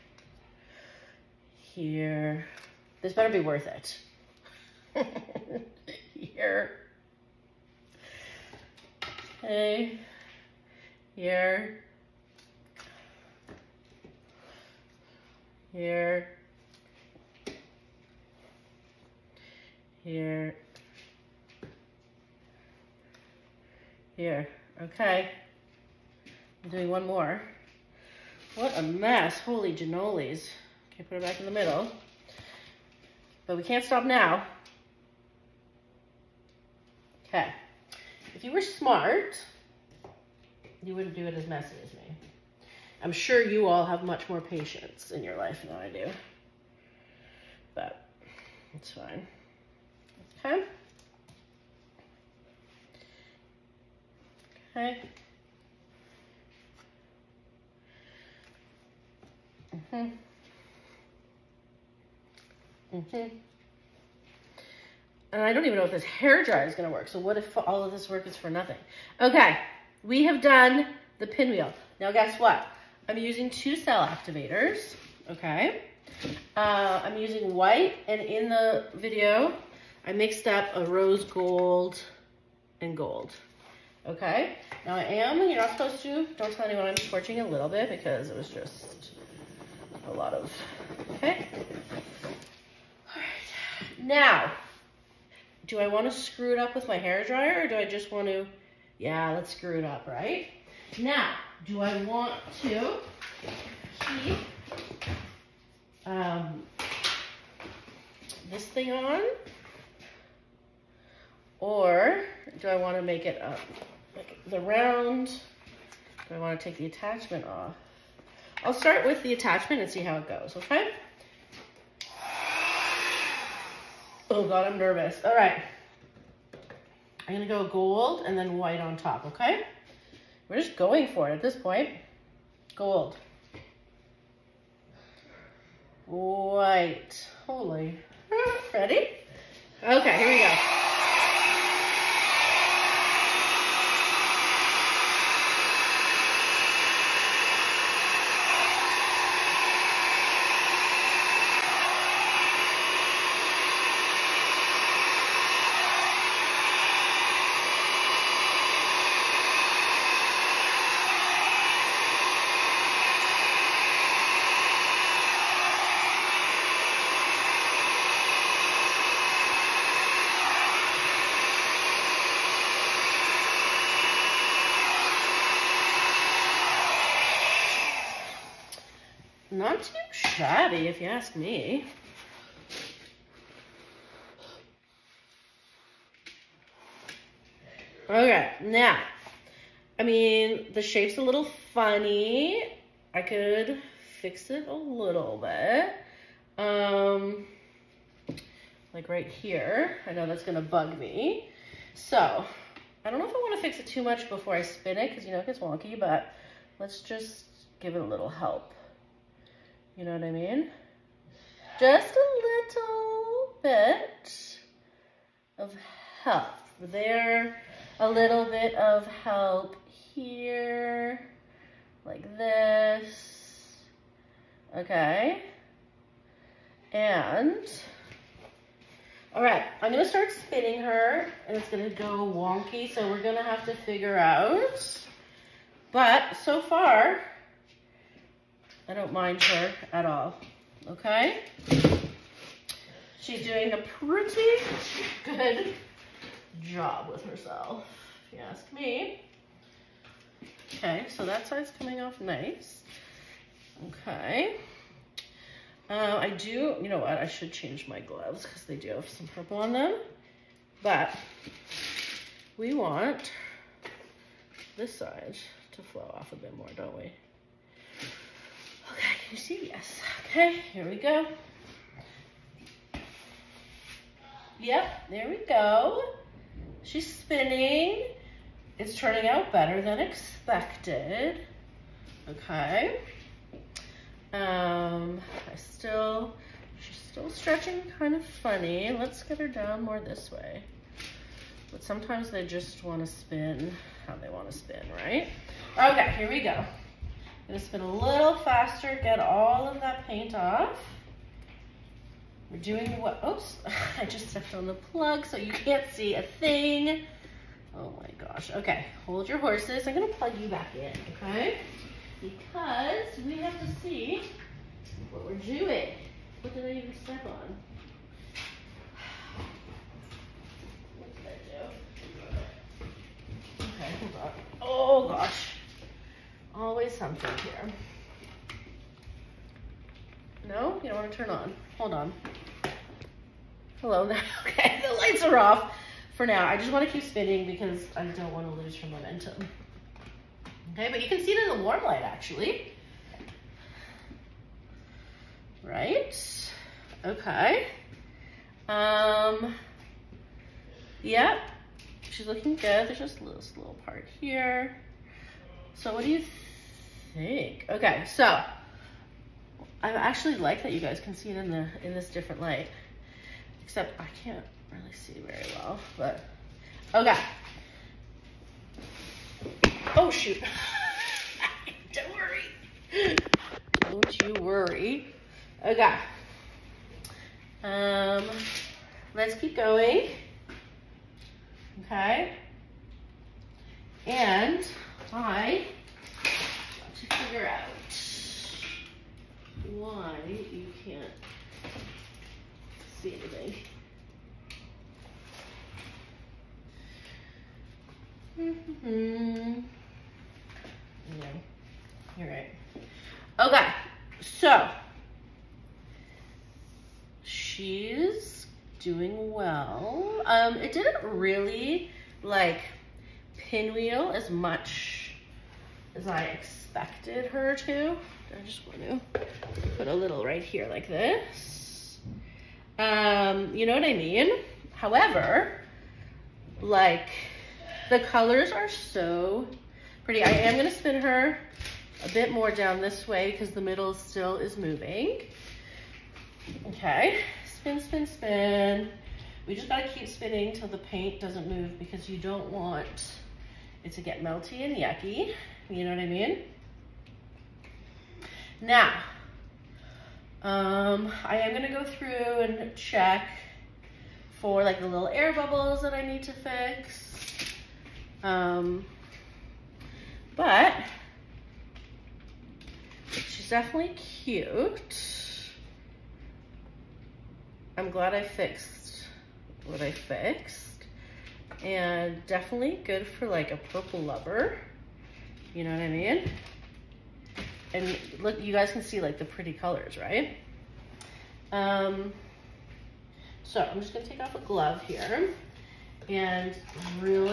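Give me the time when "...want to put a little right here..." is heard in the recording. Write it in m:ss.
6:58.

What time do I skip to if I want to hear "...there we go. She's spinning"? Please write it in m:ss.
4:35.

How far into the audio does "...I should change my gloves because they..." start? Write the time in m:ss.
4:17.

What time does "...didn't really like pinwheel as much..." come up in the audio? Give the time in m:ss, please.
6:50.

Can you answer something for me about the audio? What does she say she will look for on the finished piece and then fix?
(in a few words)
air bubbles.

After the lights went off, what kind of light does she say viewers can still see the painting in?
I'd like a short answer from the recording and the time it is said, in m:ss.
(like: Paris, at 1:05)
warm light, at 5:41.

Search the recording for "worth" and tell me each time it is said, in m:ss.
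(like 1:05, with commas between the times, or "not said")
0:03.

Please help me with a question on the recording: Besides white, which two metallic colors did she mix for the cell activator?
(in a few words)
rose gold and gold.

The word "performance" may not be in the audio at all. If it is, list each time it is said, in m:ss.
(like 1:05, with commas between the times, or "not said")
not said.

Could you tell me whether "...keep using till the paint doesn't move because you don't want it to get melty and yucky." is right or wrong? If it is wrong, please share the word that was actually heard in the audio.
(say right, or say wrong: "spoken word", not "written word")
wrong: "spinning", not "using".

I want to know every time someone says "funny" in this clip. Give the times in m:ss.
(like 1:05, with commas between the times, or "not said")
3:11, 4:48.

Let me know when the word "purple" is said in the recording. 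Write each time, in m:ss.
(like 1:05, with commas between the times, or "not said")
4:19, 7:53.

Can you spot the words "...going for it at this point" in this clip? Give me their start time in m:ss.
2:10.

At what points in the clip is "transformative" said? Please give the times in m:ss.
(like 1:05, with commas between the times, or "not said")
not said.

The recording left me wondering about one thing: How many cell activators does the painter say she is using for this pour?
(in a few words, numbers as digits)
2.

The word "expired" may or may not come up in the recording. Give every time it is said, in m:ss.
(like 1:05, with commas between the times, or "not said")
not said.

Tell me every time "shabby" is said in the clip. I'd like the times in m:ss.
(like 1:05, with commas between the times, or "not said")
3:00.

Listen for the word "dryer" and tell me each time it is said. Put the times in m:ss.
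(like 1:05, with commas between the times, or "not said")
1:06, 1:37.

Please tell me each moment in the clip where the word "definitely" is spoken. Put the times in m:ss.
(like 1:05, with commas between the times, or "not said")
7:43, 7:52.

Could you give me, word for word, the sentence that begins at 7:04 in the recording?
However, like the colors are so pretty.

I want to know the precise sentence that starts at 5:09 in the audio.
I'm gonna plug you back in, okay?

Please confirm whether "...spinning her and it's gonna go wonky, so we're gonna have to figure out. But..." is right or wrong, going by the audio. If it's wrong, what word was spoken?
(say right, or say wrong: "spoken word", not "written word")
right.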